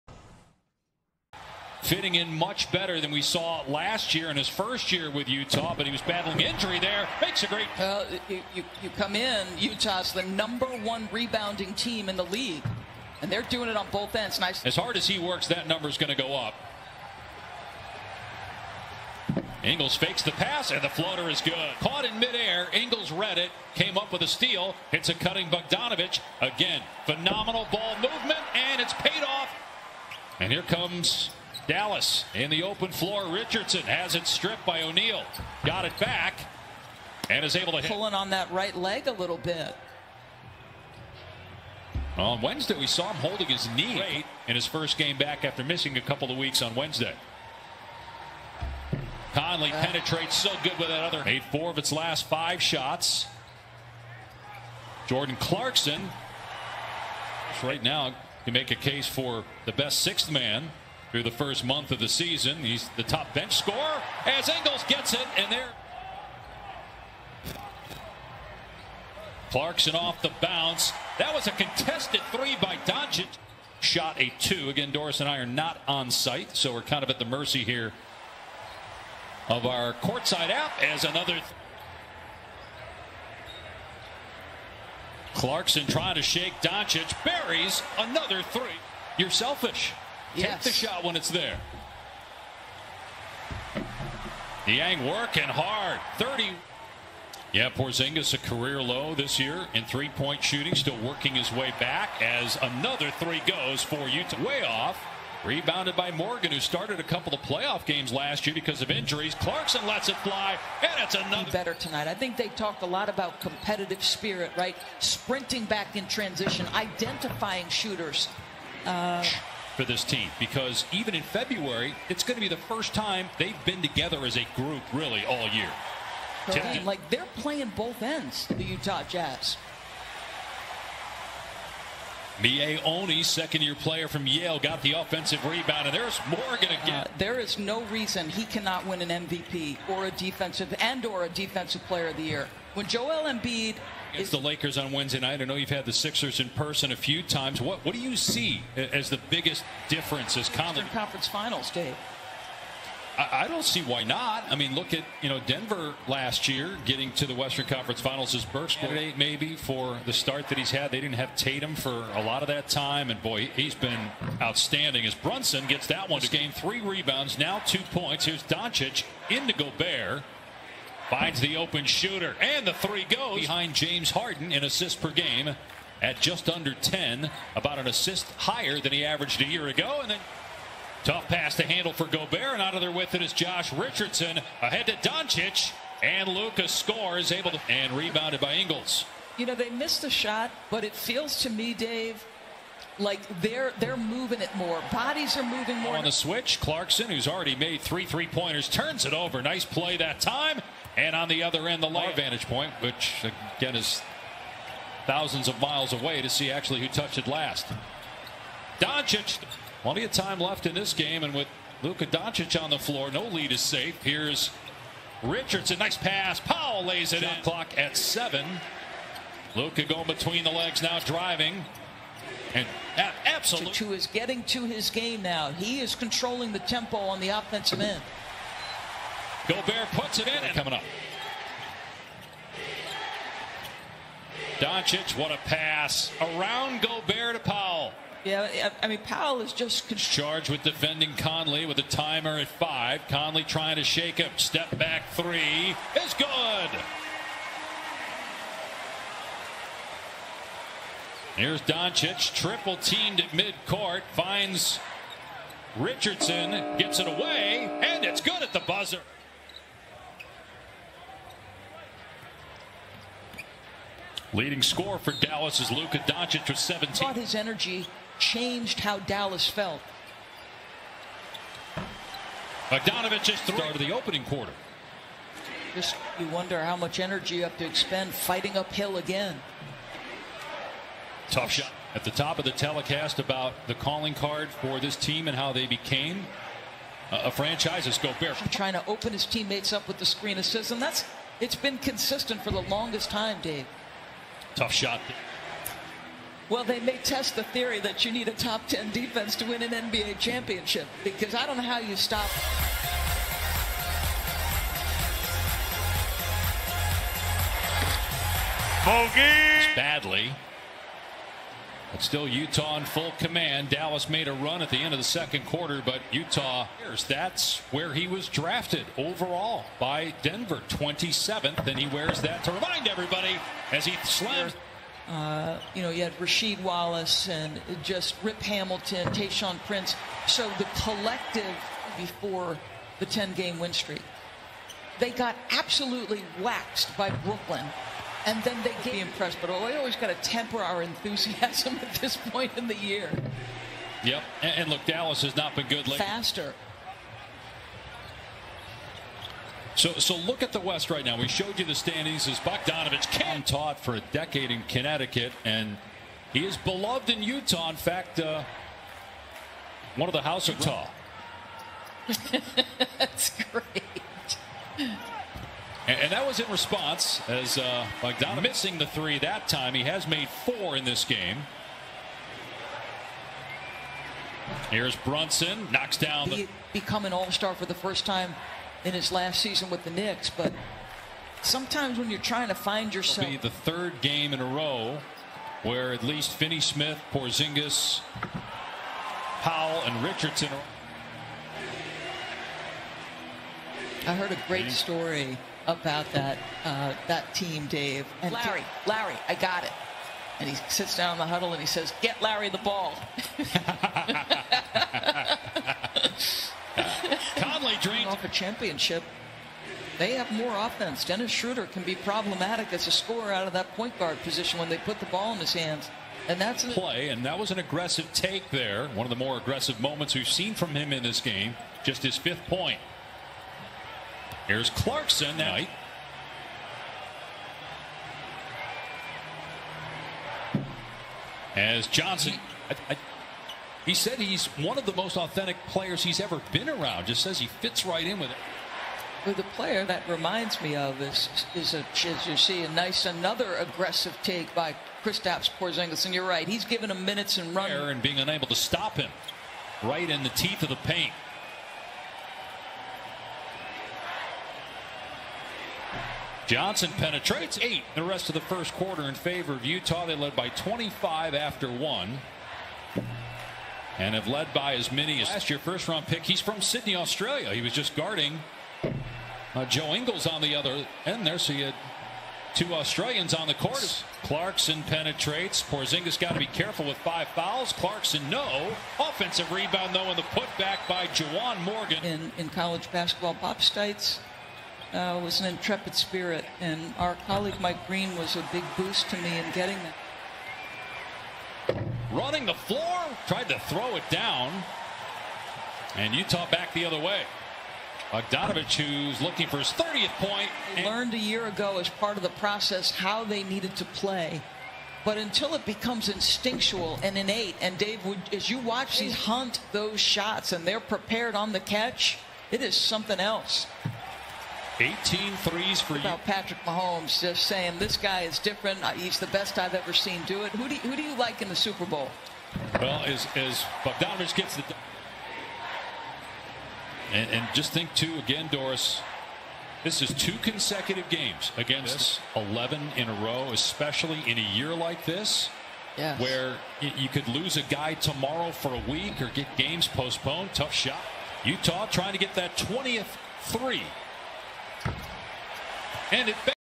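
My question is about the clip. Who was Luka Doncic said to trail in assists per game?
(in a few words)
James Harden.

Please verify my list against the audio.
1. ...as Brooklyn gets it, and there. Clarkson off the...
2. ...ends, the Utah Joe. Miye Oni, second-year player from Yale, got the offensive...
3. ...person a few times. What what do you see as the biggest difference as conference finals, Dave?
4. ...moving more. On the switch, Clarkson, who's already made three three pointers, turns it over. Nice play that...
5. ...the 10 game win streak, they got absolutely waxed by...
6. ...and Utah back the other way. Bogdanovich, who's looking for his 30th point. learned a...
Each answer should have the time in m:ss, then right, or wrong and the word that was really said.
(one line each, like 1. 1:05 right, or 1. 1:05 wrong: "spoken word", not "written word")
1. 1:04 wrong: "Ingles", not "Brooklyn"
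2. 2:08 wrong: "Jazz", not "Joe"
3. 2:26 right
4. 3:15 right
5. 5:32 right
6. 8:15 right.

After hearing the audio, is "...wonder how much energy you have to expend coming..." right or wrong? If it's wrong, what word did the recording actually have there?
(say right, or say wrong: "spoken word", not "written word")
wrong: "fighting", not "coming".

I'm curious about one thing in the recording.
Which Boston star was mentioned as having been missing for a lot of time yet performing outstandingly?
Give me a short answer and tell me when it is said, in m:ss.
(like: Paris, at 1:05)
Tatum, at 2:41.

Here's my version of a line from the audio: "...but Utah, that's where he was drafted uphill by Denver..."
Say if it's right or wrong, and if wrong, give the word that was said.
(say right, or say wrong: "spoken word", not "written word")
wrong: "overall", not "uphill".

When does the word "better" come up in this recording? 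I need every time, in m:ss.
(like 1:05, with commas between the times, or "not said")
0:02, 1:51.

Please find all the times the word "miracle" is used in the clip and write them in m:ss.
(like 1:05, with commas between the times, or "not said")
not said.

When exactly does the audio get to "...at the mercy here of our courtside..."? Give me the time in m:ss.
1:17.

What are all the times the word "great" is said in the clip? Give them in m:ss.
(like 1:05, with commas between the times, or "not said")
0:07, 0:43, 2:38, 6:03, 6:34.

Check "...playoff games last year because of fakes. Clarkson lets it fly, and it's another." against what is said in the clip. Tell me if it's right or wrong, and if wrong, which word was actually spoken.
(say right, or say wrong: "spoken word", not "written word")
wrong: "injuries", not "fakes".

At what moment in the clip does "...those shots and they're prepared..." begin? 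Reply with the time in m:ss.
8:29.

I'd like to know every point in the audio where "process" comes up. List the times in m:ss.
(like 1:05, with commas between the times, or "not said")
8:22.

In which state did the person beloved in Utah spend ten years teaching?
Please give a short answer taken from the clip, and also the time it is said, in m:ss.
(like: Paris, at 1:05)
Connecticut, at 5:54.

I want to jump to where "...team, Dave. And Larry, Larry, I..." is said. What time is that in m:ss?
6:37.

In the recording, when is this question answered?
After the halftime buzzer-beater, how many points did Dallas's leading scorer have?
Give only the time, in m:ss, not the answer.
4:26.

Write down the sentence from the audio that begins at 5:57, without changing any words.
In fact, uh, one of the House of Utah.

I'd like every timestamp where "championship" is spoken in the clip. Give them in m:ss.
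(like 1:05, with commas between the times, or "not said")
5:00, 6:48.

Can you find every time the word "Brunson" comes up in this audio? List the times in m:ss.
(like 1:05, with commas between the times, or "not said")
2:45, 6:14.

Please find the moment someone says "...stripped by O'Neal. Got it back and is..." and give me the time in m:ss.
0:34.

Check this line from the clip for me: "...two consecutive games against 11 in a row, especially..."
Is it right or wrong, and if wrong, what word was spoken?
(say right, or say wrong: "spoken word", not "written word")
right.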